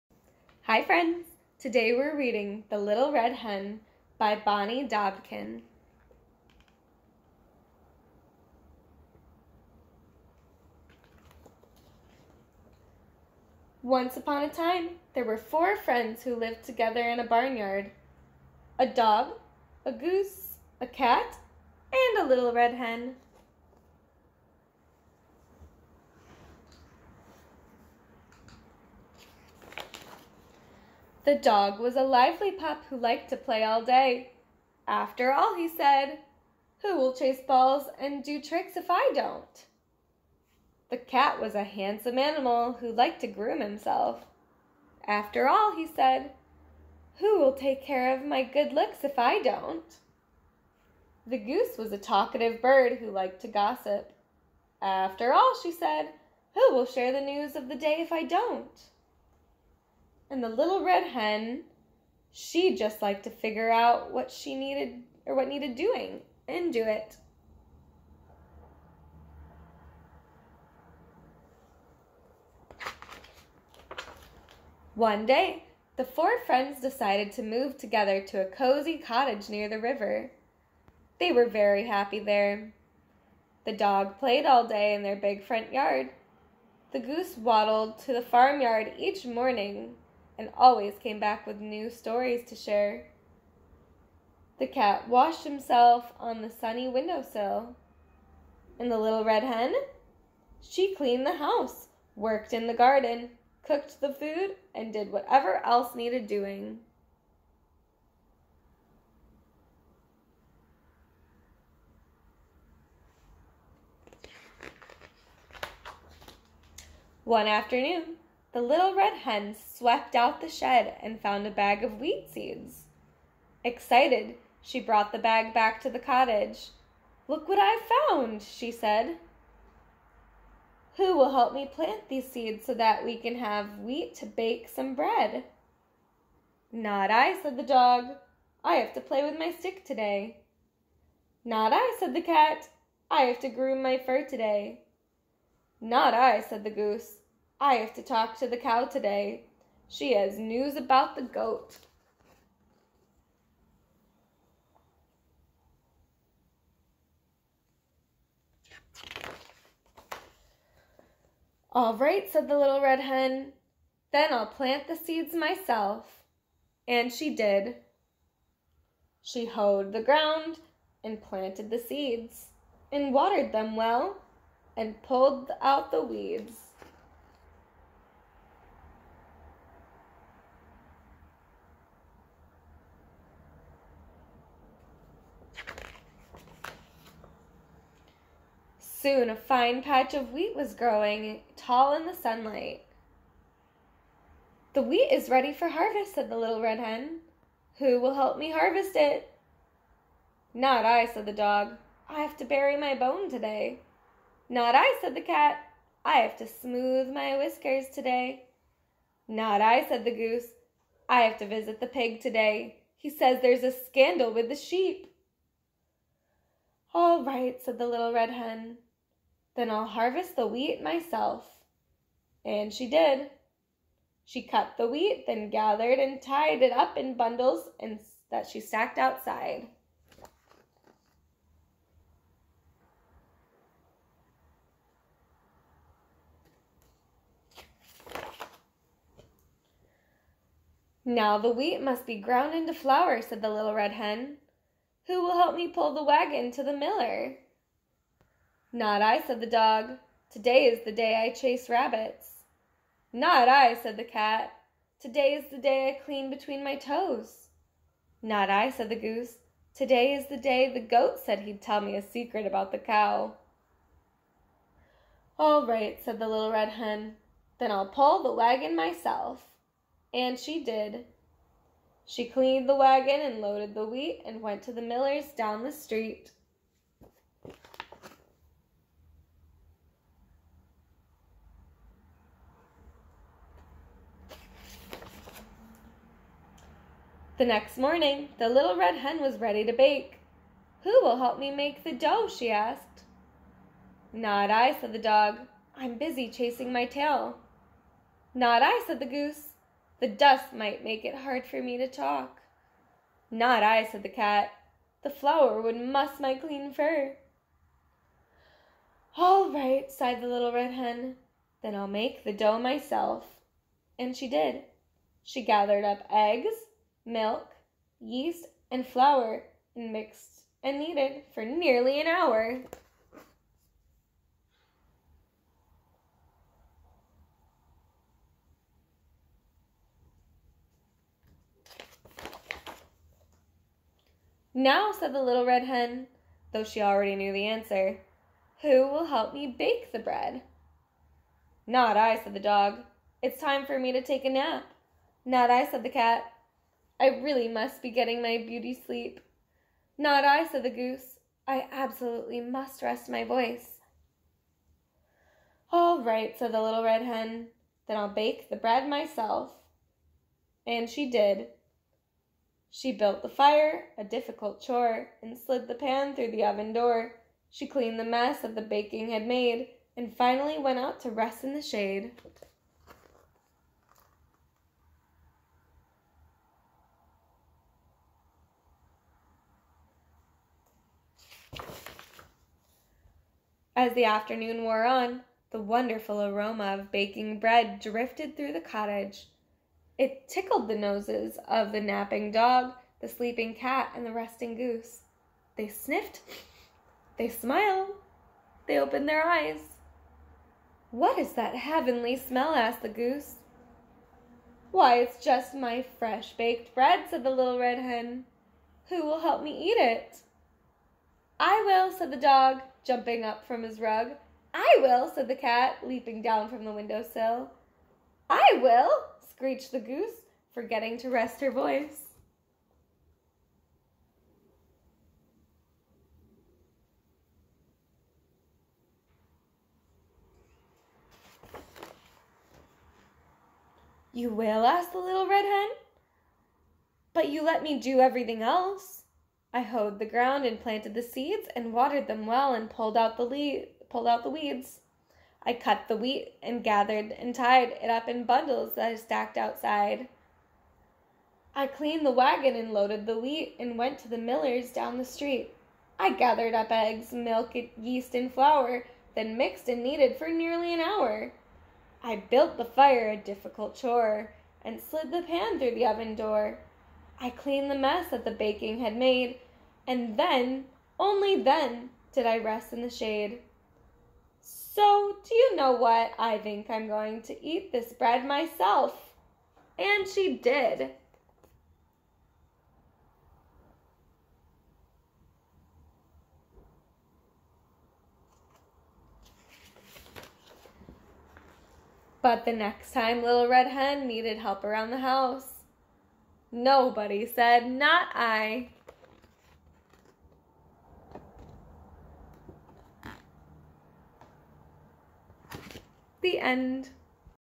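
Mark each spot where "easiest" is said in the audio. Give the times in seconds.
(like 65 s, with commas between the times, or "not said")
not said.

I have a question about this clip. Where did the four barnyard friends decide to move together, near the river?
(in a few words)
a cozy cottage.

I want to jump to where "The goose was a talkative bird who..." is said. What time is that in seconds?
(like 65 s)
51 s.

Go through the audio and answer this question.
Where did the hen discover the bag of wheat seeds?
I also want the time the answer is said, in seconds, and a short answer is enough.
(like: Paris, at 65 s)
the shed, at 119 s.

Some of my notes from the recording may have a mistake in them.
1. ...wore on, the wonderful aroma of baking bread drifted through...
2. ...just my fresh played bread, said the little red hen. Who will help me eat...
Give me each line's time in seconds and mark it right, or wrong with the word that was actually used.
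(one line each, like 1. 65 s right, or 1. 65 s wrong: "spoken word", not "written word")
1. 384 s right
2. 405 s wrong: "baked", not "played".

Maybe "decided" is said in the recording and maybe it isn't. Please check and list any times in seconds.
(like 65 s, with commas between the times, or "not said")
76 s.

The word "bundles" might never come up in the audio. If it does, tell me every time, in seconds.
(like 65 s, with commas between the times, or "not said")
227 s, 448 s.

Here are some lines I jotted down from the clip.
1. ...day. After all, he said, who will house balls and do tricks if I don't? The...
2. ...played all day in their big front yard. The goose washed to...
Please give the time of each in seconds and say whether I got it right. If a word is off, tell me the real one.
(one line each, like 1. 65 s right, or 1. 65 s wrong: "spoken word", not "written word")
1. 33 s wrong: "chase", not "house"
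2. 84 s wrong: "waddled", not "washed".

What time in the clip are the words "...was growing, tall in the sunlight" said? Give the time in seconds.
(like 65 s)
190 s.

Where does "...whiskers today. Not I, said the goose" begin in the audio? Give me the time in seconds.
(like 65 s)
207 s.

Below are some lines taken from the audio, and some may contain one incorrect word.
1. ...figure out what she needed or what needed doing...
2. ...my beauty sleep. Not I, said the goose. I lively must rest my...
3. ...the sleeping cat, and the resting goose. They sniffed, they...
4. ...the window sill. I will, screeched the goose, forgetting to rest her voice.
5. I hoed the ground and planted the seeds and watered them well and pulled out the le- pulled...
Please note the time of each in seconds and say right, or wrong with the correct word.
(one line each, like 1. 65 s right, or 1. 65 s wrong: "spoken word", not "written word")
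1. 63 s right
2. 348 s wrong: "absolutely", not "lively"
3. 392 s right
4. 416 s right
5. 439 s right.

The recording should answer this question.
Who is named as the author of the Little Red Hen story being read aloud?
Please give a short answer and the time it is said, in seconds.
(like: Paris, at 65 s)
Bonnie Dobkin, at 4 s.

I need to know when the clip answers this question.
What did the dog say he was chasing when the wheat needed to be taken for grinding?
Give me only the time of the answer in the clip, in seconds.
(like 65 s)
251 s.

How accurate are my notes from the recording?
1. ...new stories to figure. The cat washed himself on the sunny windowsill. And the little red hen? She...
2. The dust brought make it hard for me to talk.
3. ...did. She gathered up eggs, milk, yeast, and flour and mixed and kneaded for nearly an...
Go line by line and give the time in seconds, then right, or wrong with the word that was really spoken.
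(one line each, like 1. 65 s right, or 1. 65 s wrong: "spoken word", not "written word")
1. 91 s wrong: "share", not "figure"
2. 299 s wrong: "might", not "brought"
3. 314 s right.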